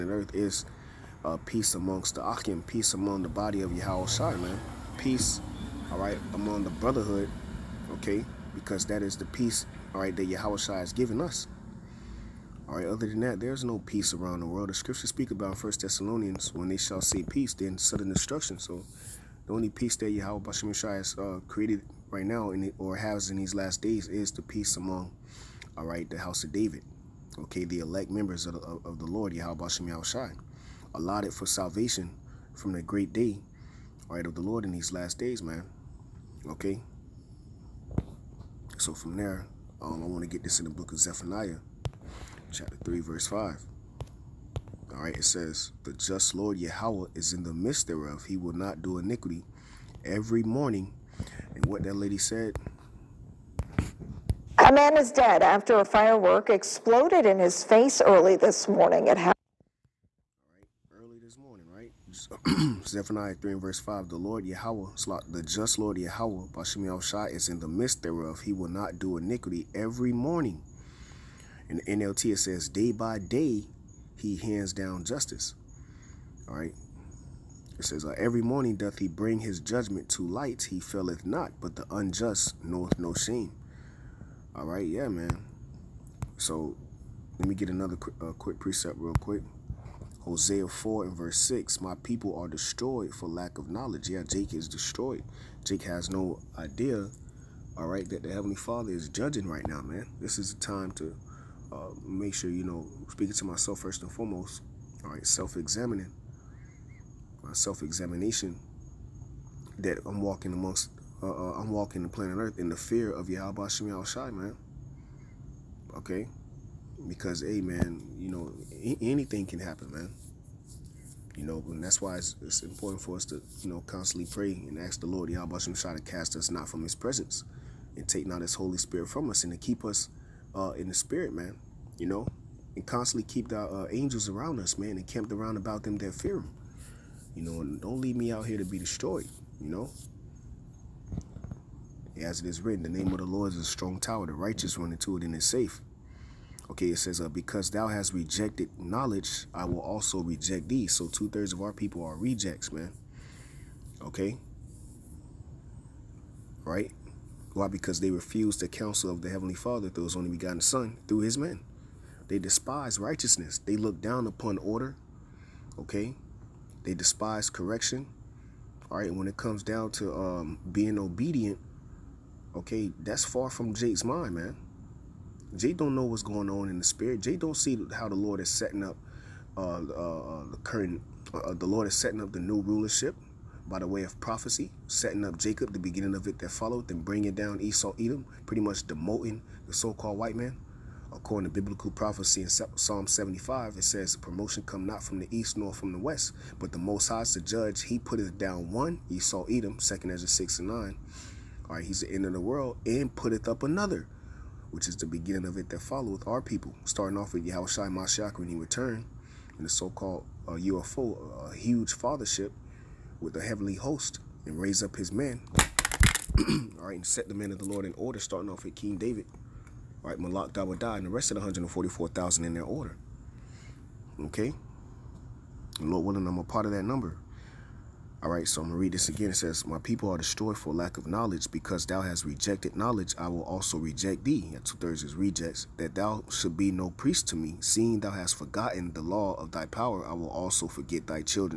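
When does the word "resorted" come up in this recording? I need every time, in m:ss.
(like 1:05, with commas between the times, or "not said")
not said.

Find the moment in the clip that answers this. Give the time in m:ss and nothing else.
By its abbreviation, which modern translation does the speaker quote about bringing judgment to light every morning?
1:11.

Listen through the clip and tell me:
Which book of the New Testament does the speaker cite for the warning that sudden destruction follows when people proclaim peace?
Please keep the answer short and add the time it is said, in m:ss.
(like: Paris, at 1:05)
First Thessalonians, at 0:15.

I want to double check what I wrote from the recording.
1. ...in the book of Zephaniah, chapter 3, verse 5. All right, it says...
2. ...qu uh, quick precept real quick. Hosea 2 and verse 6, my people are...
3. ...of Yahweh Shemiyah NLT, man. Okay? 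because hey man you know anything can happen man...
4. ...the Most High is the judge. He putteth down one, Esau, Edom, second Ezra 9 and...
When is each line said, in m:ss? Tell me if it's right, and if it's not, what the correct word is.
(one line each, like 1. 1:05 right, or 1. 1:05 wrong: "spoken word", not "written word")
1. 0:40 right
2. 1:27 wrong: "4", not "2"
3. 1:53 wrong: "Shai", not "NLT"
4. 3:16 wrong: "6", not "9".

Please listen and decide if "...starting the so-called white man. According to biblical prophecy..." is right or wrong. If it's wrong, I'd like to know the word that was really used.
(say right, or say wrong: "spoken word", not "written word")
wrong: "demoting", not "starting".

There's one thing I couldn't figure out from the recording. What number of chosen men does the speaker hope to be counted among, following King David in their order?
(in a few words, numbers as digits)
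144,000.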